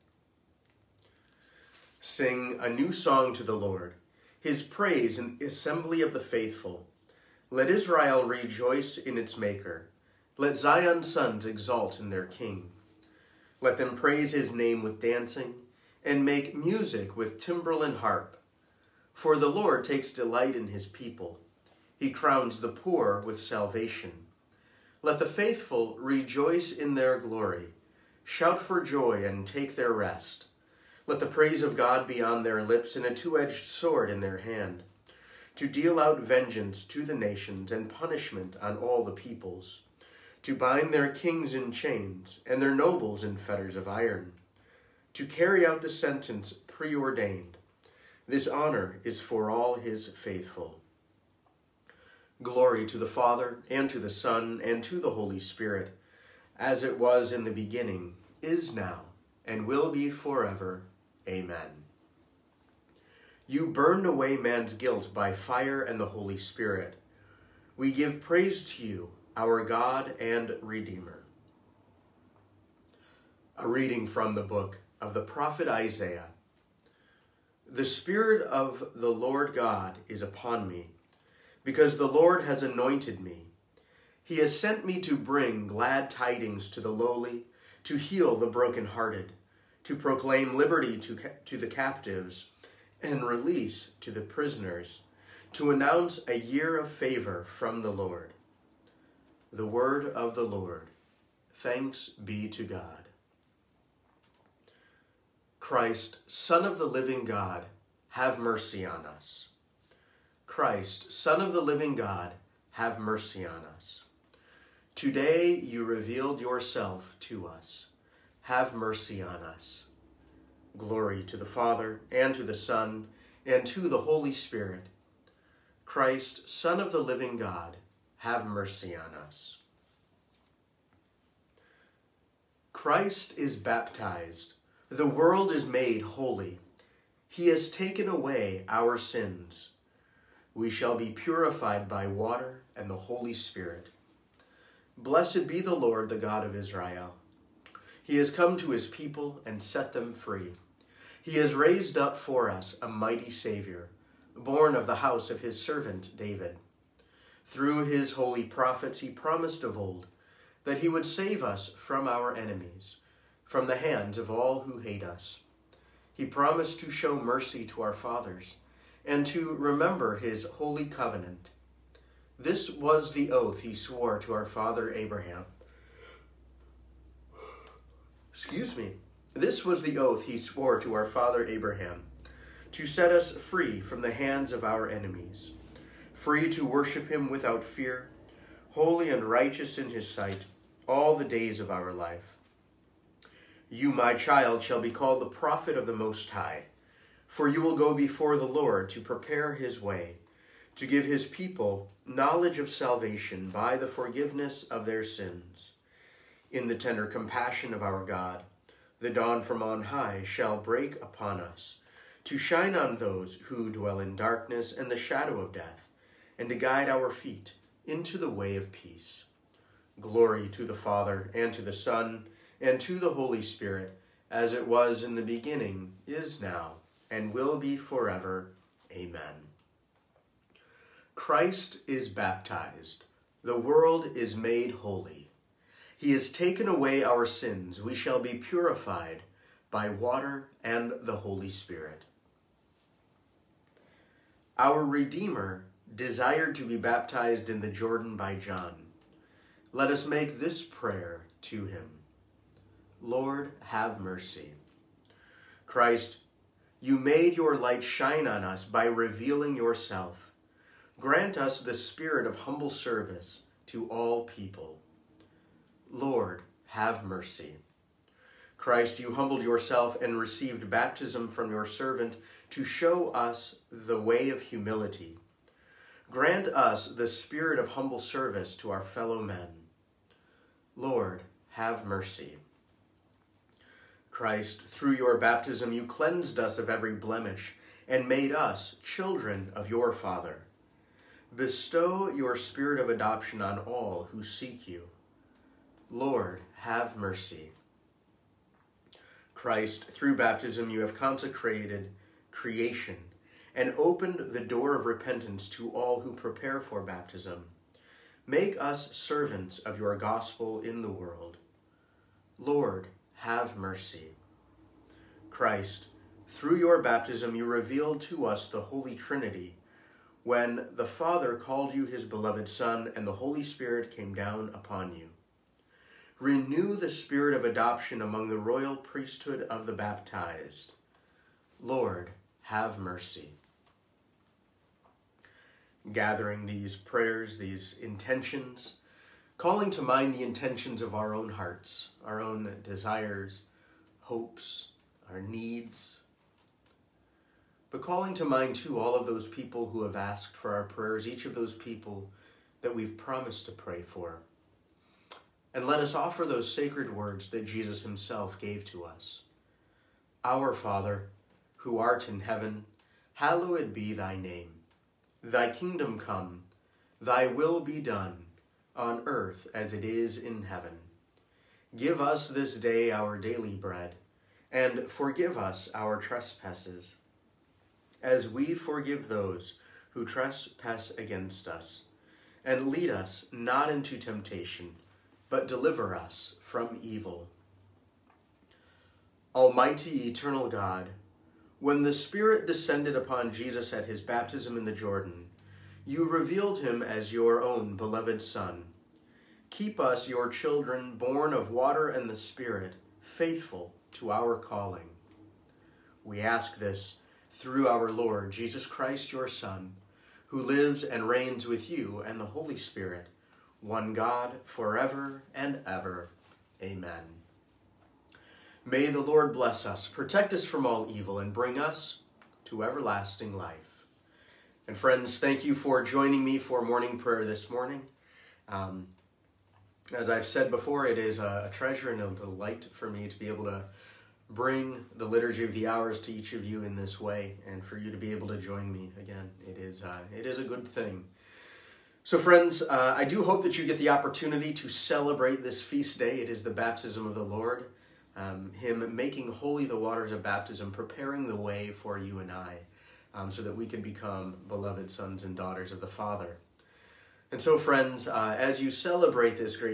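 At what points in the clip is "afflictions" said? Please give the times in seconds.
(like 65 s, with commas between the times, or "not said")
not said.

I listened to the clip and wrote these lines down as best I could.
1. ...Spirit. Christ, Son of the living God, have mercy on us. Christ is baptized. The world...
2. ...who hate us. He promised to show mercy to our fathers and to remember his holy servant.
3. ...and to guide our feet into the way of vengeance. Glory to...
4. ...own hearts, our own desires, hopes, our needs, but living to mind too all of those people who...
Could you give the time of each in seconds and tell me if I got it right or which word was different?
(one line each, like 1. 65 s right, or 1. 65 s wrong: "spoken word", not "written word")
1. 124 s right
2. 164 s wrong: "covenant", not "servant"
3. 216 s wrong: "peace", not "vengeance"
4. 341 s wrong: "calling", not "living".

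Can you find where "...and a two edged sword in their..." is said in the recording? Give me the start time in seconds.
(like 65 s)
32 s.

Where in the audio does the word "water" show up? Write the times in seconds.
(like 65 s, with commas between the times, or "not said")
142 s, 239 s, 401 s, 449 s.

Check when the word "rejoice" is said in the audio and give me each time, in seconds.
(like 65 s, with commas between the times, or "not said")
8 s, 25 s.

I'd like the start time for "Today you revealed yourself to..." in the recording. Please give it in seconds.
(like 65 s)
114 s.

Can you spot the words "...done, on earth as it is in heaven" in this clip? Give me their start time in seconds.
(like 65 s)
367 s.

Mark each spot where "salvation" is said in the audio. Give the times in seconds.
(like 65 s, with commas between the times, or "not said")
23 s, 202 s.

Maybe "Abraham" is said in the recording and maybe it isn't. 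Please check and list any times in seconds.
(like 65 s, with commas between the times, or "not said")
174 s, 181 s.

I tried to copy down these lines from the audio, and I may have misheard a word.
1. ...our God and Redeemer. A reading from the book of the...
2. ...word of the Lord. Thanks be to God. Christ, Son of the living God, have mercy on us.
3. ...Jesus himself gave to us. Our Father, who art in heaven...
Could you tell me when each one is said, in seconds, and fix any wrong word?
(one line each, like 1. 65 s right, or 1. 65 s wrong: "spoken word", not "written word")
1. 69 s right
2. 99 s right
3. 357 s right.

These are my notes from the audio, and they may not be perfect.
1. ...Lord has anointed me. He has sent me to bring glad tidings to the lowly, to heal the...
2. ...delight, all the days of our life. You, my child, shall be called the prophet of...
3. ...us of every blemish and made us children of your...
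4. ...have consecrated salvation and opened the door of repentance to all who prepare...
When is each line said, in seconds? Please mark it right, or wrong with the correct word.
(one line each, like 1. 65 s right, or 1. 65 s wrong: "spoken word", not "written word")
1. 82 s right
2. 190 s wrong: "sight", not "delight"
3. 286 s right
4. 300 s wrong: "creation", not "salvation".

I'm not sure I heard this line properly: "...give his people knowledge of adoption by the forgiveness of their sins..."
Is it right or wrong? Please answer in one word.
wrong.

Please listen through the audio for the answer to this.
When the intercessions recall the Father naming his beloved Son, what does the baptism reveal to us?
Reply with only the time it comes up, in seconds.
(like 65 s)
318 s.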